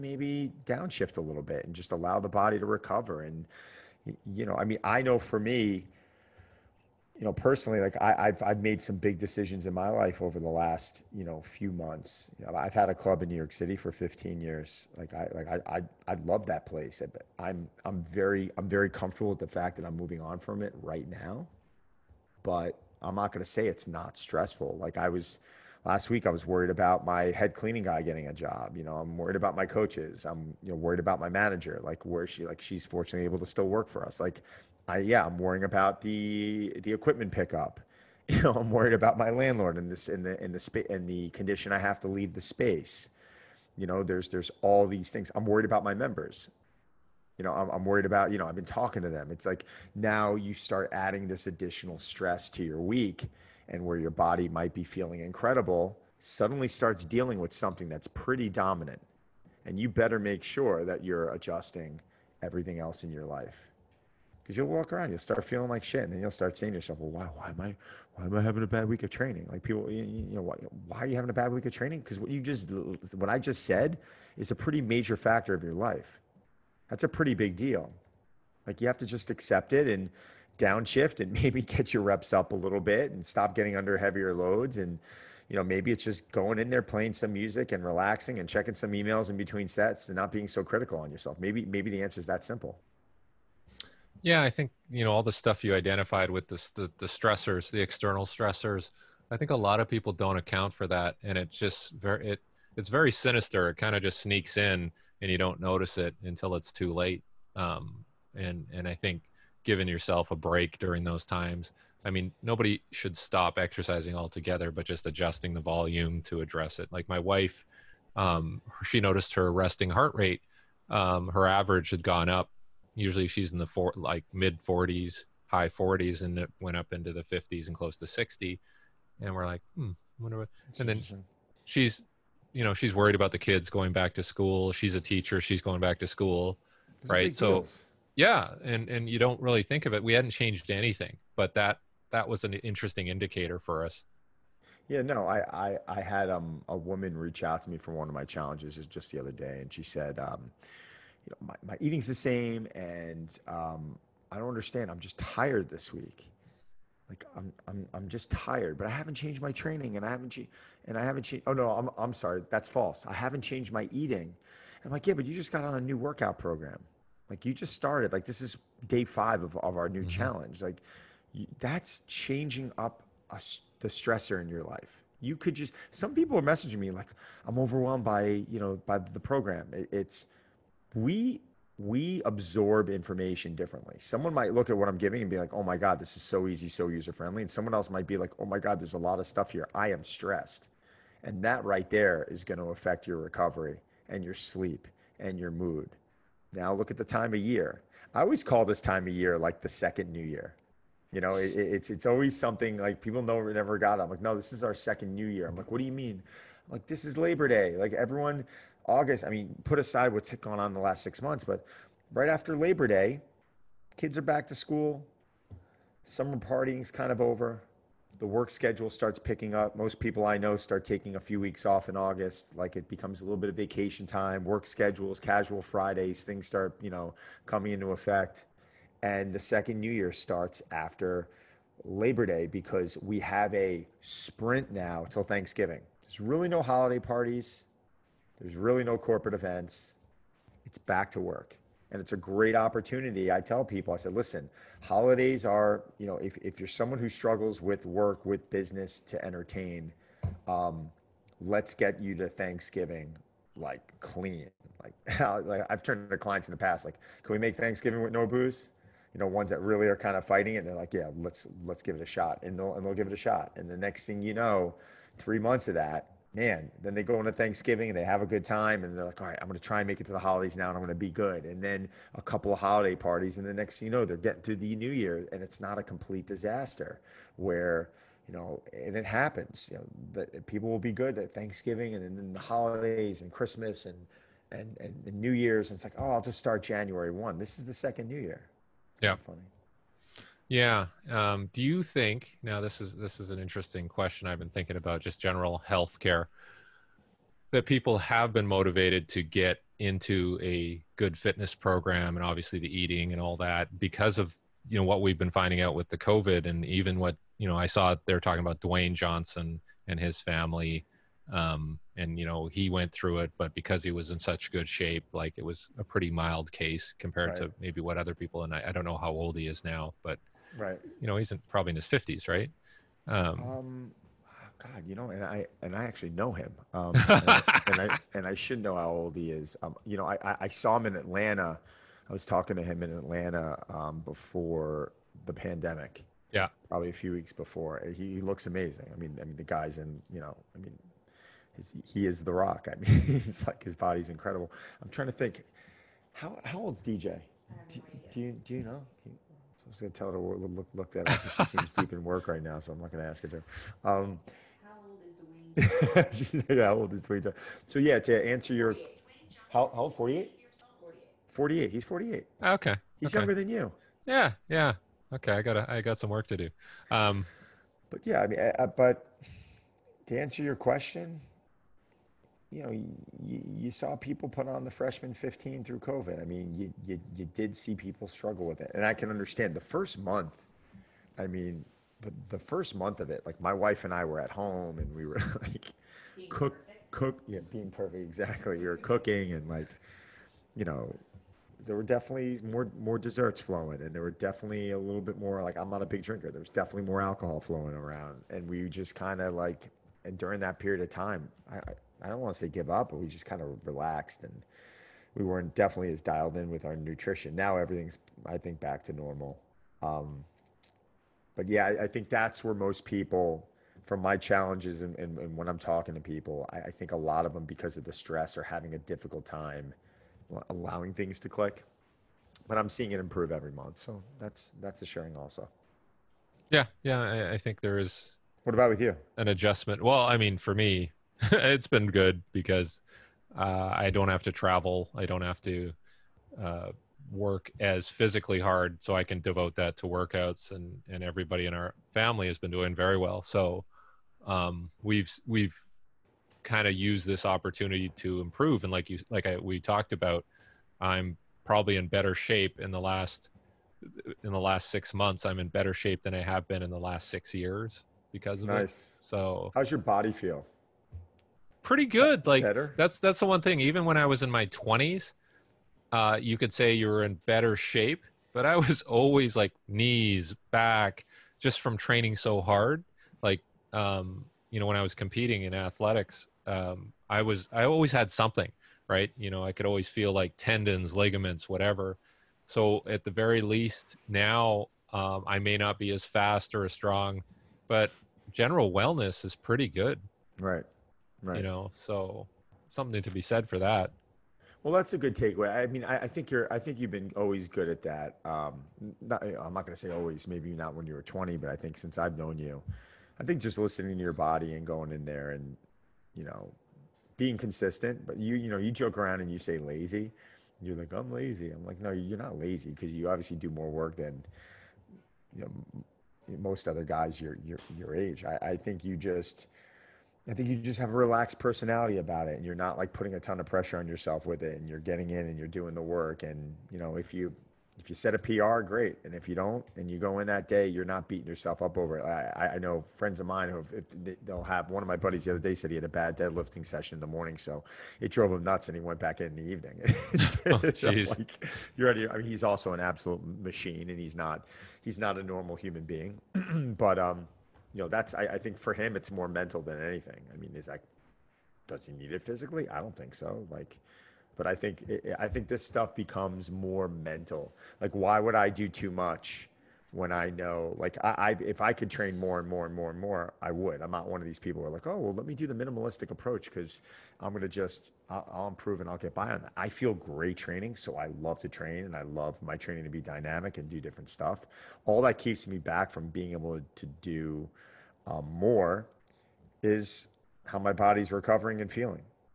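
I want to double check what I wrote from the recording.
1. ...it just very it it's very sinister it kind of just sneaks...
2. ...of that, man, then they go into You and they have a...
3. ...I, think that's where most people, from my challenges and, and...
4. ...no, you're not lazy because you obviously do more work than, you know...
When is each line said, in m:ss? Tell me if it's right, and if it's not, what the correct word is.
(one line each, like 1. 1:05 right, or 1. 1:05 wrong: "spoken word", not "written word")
1. 1:41 right
2. 4:25 wrong: "Thanksgiving", not "You"
3. 6:51 right
4. 8:31 right.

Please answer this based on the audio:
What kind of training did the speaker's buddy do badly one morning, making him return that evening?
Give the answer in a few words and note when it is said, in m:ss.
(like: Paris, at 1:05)
Deadlifting, at 8:56.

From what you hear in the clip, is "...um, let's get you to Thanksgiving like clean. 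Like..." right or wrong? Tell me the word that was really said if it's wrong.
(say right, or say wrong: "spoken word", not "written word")
right.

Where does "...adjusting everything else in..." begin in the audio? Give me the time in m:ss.
1:01.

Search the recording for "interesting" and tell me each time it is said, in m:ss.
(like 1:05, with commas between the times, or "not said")
2:22, 4:53.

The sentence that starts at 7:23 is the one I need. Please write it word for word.
So um, we've we've kind of used this opportunity to improve.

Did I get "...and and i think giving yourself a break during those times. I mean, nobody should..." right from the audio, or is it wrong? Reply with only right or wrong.
right.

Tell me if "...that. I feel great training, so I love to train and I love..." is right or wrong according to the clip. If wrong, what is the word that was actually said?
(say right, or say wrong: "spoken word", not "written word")
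right.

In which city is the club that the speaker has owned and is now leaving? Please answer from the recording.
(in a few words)
New York City.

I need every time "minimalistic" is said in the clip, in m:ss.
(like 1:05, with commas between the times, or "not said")
9:25.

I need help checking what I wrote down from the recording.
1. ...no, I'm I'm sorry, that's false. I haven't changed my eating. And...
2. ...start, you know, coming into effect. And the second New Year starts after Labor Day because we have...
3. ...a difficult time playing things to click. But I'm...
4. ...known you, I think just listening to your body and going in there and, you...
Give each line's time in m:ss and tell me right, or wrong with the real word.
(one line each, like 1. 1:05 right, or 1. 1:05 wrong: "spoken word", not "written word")
1. 2:41 right
2. 3:46 right
3. 6:58 wrong: "allowing", not "playing"
4. 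8:22 right.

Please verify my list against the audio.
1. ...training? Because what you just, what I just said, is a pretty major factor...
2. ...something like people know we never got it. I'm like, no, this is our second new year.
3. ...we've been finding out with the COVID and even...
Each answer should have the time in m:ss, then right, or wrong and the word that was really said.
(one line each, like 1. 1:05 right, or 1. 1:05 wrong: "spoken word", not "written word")
1. 1:11 right
2. 3:22 right
3. 5:05 right.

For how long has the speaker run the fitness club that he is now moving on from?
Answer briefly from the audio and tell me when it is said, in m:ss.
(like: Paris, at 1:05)
15 years, at 0:13.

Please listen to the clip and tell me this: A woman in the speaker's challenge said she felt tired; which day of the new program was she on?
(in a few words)
Day 5.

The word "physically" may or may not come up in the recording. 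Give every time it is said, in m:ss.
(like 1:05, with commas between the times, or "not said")
7:17, 9:12.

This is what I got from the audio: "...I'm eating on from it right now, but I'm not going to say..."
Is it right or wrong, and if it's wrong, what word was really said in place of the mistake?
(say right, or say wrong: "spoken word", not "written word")
wrong: "moving", not "eating".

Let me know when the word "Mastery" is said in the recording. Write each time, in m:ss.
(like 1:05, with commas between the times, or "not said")
not said.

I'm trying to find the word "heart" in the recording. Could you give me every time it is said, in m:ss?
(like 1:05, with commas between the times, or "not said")
1:59.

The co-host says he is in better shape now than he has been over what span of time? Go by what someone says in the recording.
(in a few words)
6 years.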